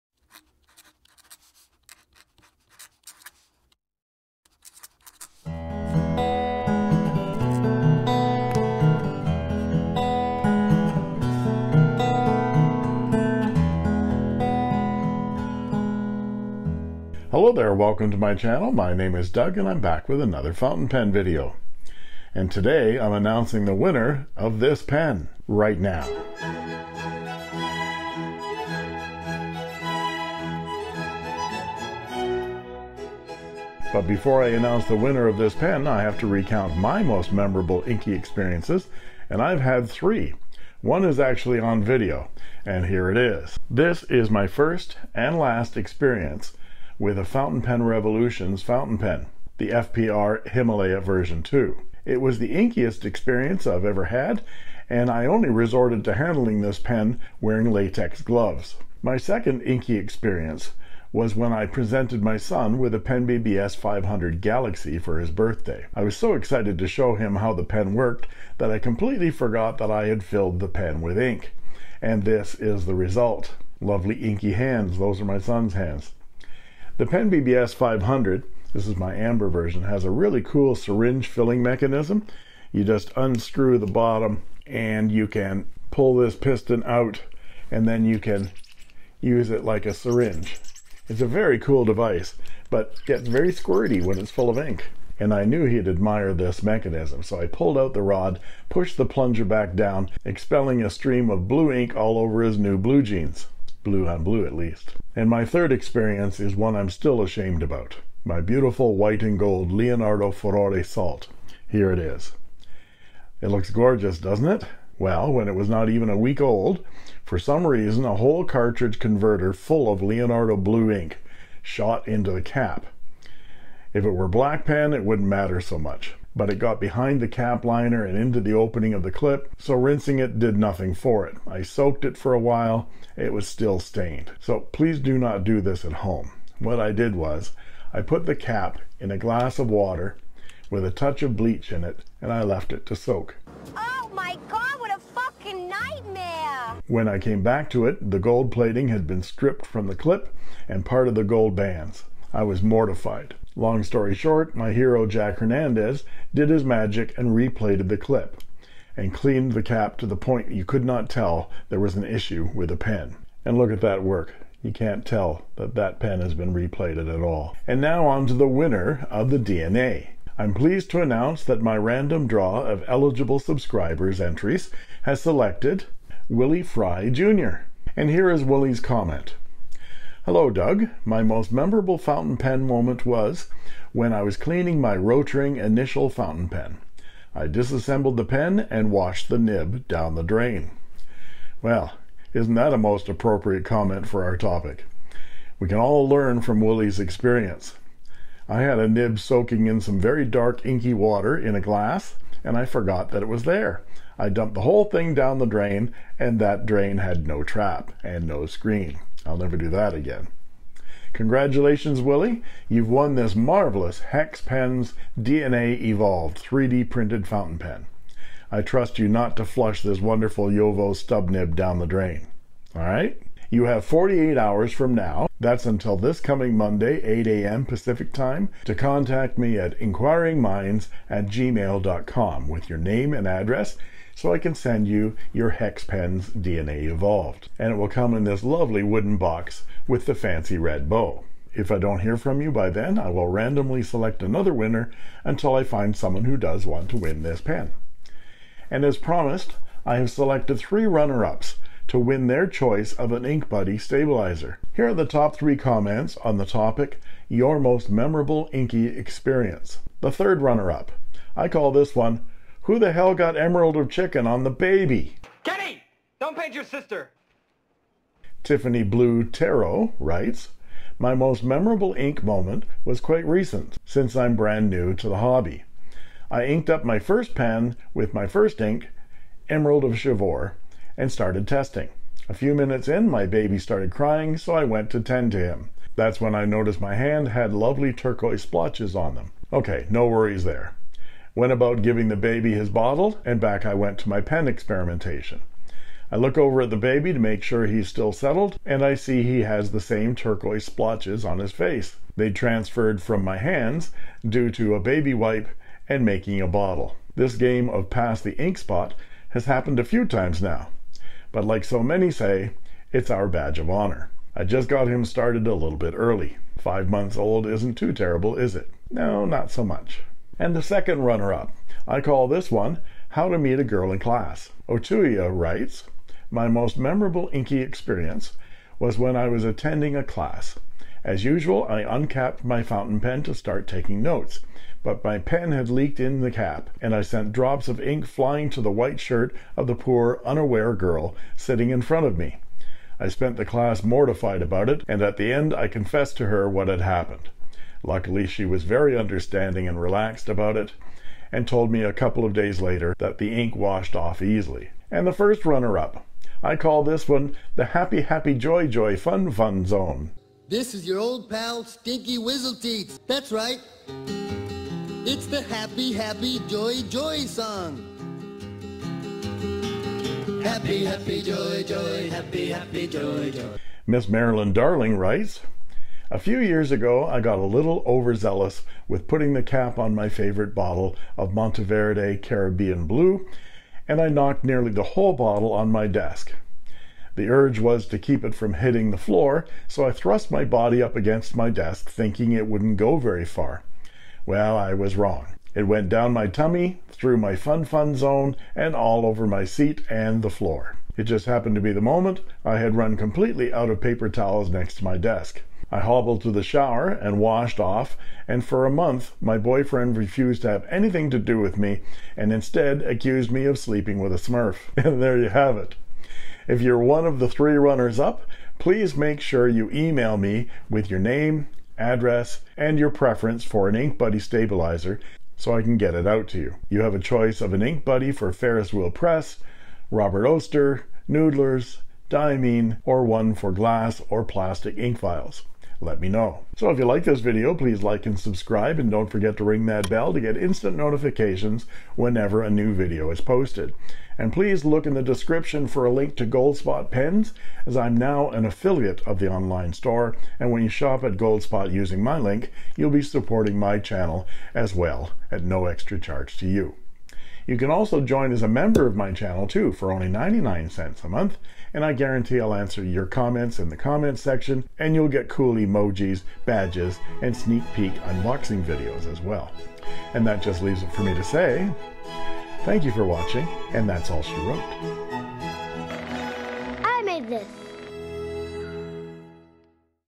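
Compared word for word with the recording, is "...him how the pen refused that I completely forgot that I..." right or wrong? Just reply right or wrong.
wrong.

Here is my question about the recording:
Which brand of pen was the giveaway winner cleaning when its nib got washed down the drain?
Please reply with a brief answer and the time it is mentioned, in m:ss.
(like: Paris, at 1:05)
Rotring, at 3:04.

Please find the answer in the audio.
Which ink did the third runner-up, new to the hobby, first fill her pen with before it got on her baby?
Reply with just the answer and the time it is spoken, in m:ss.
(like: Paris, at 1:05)
Emerald of Chivor, at 4:39.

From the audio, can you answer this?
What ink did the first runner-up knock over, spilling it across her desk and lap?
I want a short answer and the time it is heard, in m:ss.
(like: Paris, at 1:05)
Monteverde Caribbean Blue, at 6:21.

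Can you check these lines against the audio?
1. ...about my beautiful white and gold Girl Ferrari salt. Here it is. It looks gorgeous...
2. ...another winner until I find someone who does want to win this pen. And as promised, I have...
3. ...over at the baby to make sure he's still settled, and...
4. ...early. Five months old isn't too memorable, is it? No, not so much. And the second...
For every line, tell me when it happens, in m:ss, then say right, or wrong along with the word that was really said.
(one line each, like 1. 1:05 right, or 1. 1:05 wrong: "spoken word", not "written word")
1. 1:47 wrong: "Leonardo", not "Girl"
2. 4:04 right
3. 4:56 right
4. 5:15 wrong: "terrible", not "memorable".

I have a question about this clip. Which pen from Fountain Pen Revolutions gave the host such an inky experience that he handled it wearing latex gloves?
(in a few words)
FPR Himalaya version 2.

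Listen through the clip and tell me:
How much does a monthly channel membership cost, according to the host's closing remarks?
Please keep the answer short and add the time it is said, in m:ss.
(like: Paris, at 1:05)
99 cents, at 7:40.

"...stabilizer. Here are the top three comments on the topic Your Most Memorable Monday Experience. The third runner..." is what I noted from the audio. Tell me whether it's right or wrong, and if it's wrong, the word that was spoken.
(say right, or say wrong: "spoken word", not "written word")
wrong: "Inky", not "Monday".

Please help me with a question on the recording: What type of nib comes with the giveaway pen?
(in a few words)
Jowo stub nib.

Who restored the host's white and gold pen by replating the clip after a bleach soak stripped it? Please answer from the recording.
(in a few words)
Jack Hernandez.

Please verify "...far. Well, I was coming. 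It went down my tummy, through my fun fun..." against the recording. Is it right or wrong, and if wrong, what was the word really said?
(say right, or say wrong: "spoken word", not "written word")
wrong: "wrong", not "coming".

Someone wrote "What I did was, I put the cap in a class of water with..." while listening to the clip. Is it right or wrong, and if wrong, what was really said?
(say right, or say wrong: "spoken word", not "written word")
wrong: "glass", not "class".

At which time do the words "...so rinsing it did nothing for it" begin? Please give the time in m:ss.
2:09.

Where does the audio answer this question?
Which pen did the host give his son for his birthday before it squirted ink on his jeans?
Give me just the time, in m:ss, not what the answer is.
1:02.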